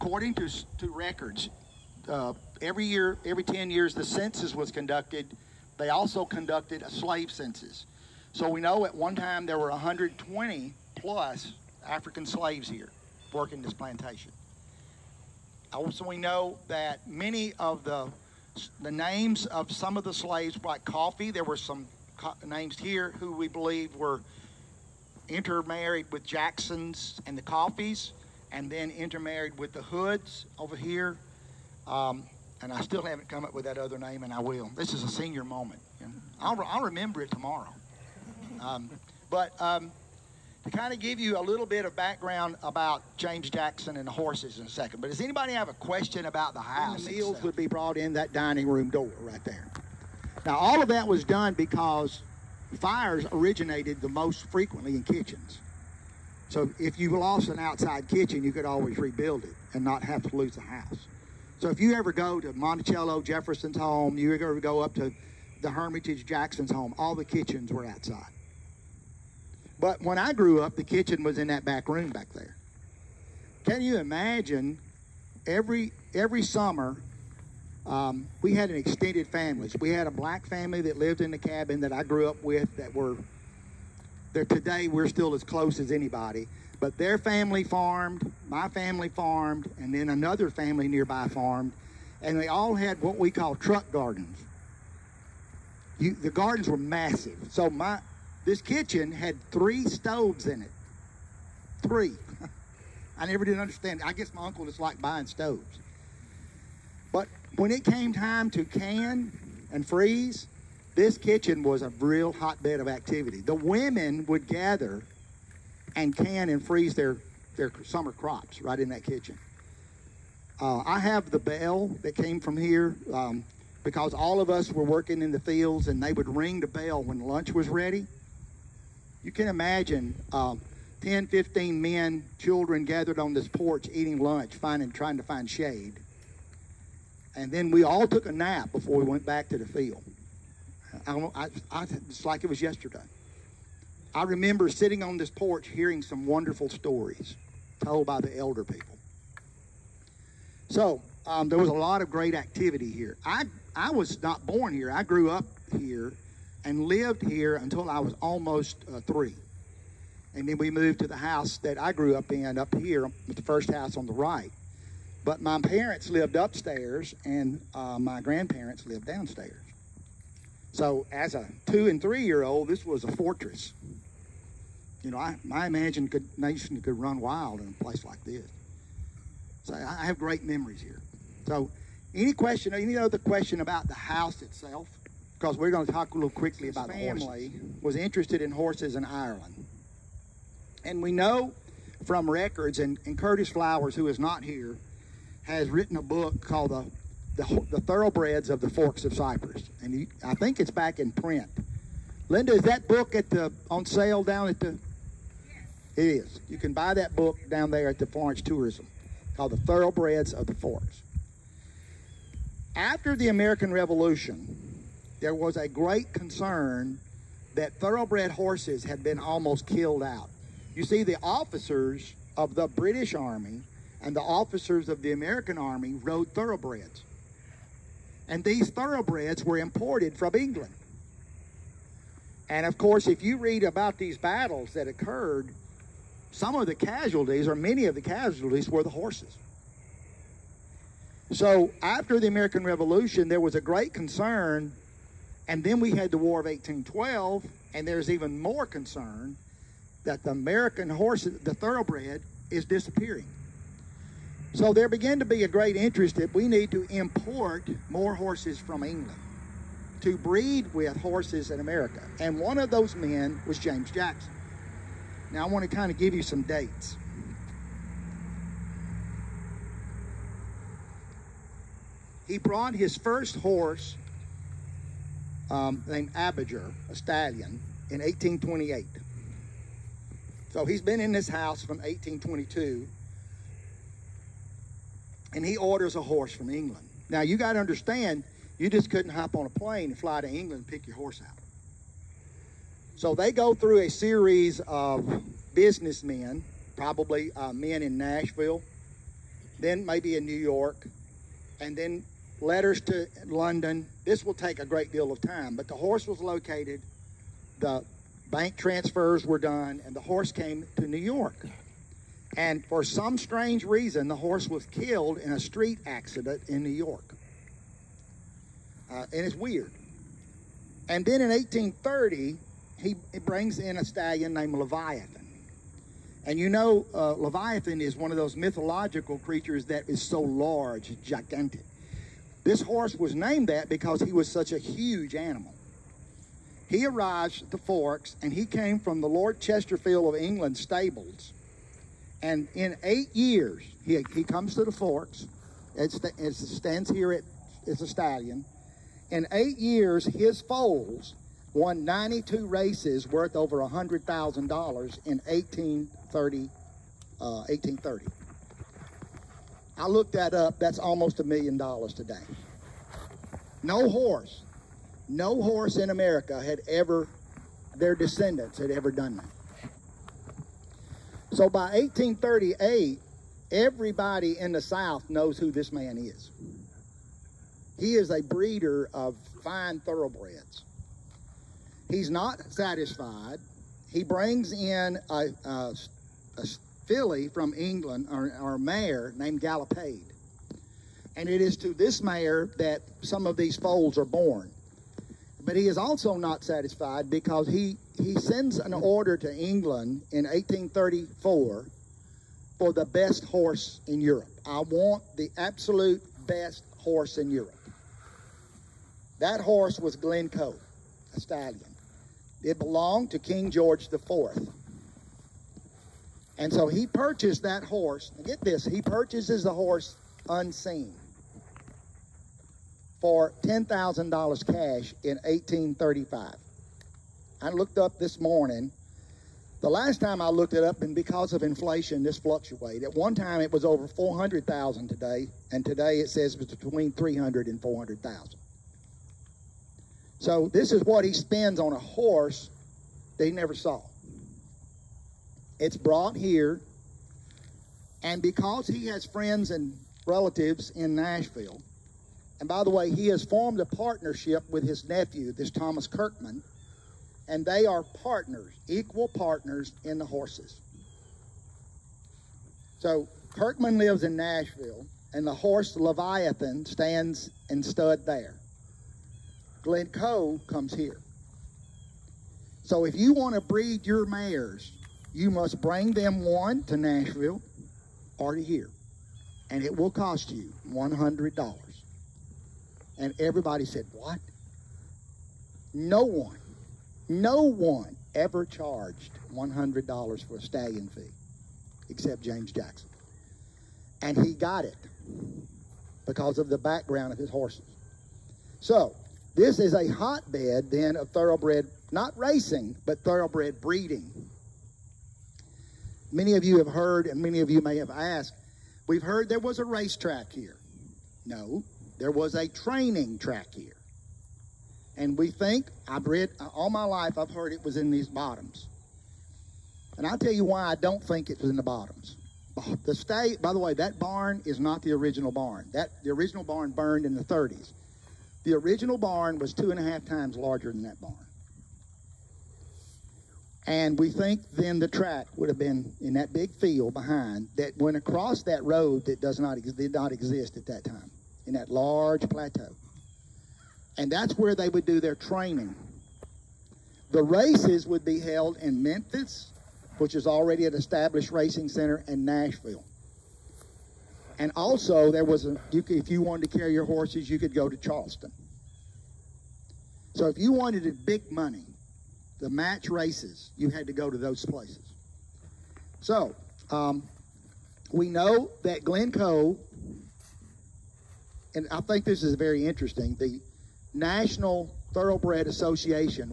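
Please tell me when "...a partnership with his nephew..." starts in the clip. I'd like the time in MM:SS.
07:33.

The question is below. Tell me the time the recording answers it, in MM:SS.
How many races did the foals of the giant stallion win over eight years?
05:51.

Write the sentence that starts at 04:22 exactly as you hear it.
And one of those men was James Jackson.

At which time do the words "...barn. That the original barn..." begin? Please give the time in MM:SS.
08:45.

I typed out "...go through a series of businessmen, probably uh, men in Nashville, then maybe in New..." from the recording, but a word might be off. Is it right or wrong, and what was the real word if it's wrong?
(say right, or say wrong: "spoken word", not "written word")
right.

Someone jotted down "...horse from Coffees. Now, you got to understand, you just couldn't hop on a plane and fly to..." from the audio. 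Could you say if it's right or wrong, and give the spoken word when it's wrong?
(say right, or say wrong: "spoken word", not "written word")
wrong: "England", not "Coffees".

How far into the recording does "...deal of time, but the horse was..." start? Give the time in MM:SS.
05:04.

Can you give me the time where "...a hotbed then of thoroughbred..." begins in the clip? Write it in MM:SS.
08:19.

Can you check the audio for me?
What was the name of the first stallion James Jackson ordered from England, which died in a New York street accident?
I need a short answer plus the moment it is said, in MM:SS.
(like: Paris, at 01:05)
Abiger, at 04:36.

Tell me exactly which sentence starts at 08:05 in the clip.
No one no one ever charged $100 for a stallion fee except James Jackson.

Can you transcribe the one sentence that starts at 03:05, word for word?
Because we're going to talk a little quickly about the family was interested in horses in Ireland.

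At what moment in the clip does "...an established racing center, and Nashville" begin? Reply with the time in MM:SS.
09:10.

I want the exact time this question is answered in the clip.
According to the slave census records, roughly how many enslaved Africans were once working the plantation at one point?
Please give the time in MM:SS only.
00:09.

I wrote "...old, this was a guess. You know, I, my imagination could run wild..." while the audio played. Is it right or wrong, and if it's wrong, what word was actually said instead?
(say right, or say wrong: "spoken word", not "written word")
wrong: "fortress", not "guess".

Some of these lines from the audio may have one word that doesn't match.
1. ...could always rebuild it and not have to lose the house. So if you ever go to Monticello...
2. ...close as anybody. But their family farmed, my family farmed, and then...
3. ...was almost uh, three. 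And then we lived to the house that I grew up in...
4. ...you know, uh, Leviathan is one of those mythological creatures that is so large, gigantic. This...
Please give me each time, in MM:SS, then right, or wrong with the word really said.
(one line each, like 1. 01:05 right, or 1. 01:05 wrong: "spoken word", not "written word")
1. 00:58 right
2. 01:25 right
3. 02:37 wrong: "moved", not "lived"
4. 05:26 right.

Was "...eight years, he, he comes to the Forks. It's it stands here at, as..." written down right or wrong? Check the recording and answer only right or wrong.
right.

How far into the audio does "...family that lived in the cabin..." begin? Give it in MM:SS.
01:20.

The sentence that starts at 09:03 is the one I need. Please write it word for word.
And that's where they would do their training.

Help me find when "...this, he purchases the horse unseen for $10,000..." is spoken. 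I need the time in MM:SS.
06:58.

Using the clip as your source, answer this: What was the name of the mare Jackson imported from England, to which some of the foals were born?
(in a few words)
Galopade.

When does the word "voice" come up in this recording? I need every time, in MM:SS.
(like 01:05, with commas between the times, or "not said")
not said.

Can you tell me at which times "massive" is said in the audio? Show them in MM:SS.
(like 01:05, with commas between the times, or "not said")
01:36.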